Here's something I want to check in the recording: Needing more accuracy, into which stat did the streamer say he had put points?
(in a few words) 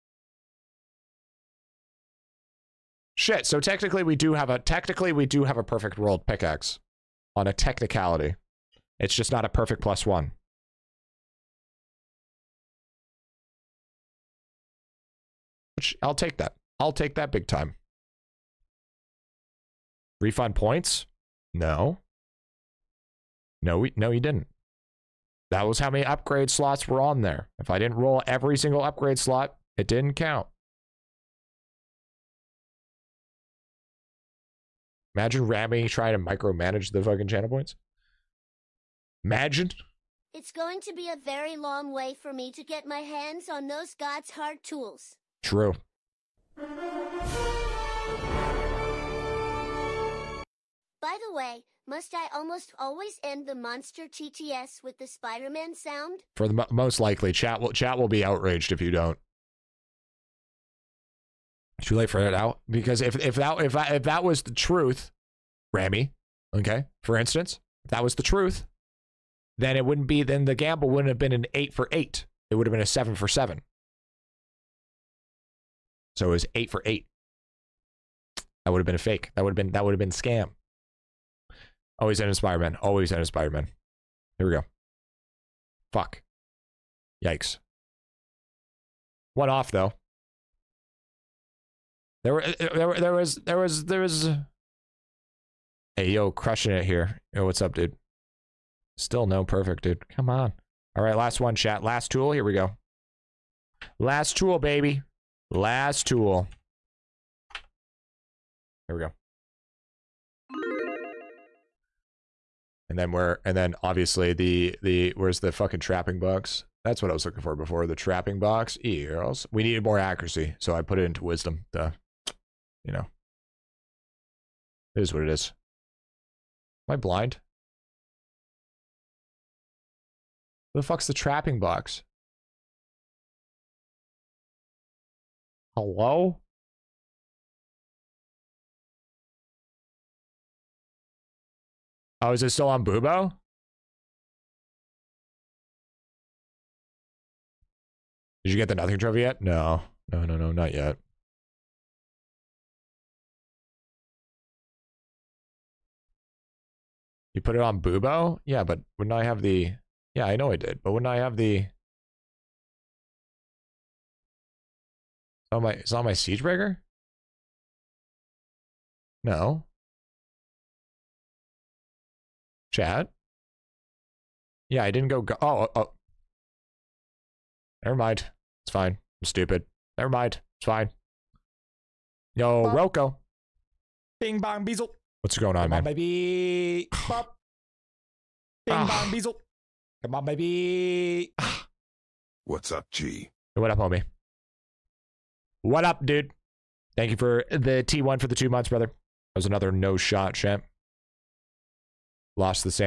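Wisdom.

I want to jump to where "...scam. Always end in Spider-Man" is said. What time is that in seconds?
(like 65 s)
80 s.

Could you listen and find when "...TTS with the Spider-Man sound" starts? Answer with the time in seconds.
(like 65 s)
54 s.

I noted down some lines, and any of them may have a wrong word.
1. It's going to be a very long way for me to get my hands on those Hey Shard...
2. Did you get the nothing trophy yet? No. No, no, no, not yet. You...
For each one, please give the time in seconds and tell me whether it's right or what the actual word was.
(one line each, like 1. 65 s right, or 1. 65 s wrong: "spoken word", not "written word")
1. 40 s wrong: "God", not "Hey"
2. 148 s right.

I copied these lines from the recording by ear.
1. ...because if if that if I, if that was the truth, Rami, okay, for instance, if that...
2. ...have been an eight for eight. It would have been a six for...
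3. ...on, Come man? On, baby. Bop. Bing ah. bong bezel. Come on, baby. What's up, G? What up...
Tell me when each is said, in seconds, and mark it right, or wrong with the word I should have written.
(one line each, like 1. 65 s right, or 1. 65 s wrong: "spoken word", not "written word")
1. 62 s right
2. 71 s wrong: "seven", not "six"
3. 185 s right.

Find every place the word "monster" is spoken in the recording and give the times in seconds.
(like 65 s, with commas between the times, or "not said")
53 s.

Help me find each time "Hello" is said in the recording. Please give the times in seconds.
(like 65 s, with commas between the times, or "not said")
135 s.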